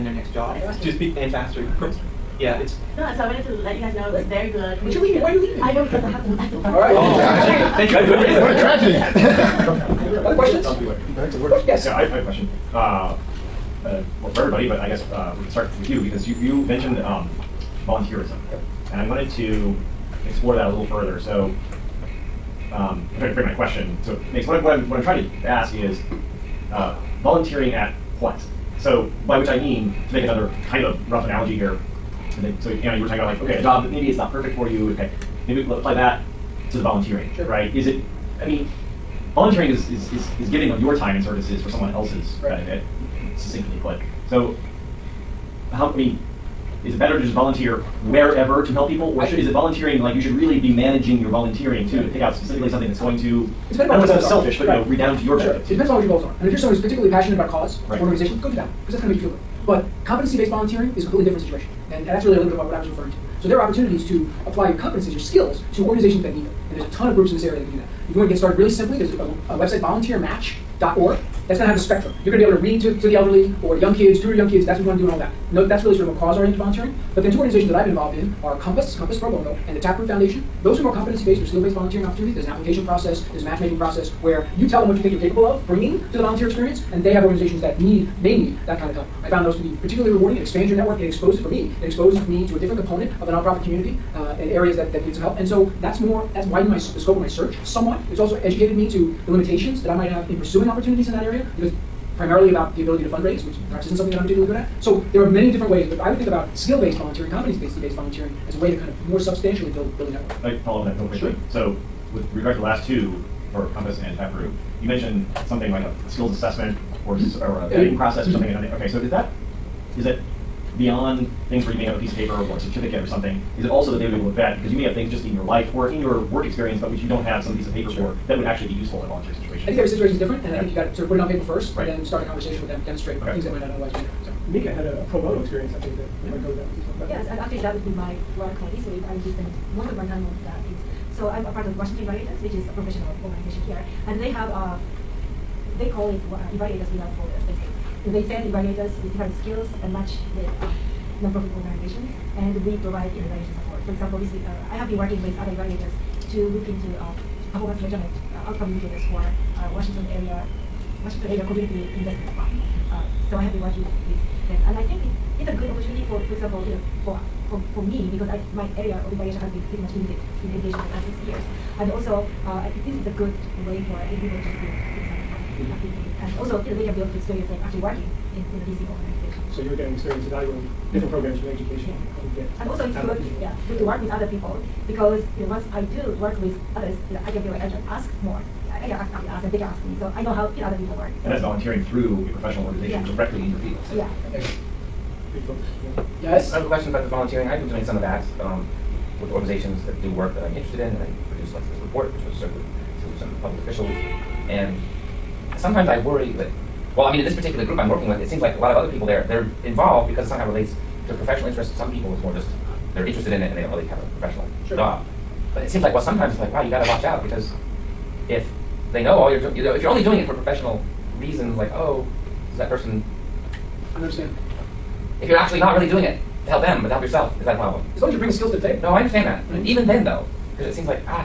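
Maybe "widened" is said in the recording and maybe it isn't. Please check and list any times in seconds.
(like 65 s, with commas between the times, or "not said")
96 s.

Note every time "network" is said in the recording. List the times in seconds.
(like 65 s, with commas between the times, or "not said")
90 s, 110 s.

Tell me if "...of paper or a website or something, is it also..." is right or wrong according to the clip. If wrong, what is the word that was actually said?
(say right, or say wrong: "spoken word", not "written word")
wrong: "certificate", not "website".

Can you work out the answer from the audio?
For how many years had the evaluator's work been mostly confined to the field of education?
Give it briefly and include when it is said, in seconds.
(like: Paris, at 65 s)
6, at 171 s.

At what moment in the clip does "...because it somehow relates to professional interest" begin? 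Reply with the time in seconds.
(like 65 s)
210 s.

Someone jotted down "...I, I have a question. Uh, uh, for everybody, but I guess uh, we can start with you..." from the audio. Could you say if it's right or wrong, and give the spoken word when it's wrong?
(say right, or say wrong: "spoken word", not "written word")
right.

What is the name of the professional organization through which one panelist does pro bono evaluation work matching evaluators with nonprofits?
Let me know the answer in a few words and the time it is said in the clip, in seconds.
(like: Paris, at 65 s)
Washington Evaluators, at 141 s.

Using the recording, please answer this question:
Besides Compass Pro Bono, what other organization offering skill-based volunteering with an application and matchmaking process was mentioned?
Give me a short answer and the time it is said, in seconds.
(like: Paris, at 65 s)
Taproot Foundation, at 79 s.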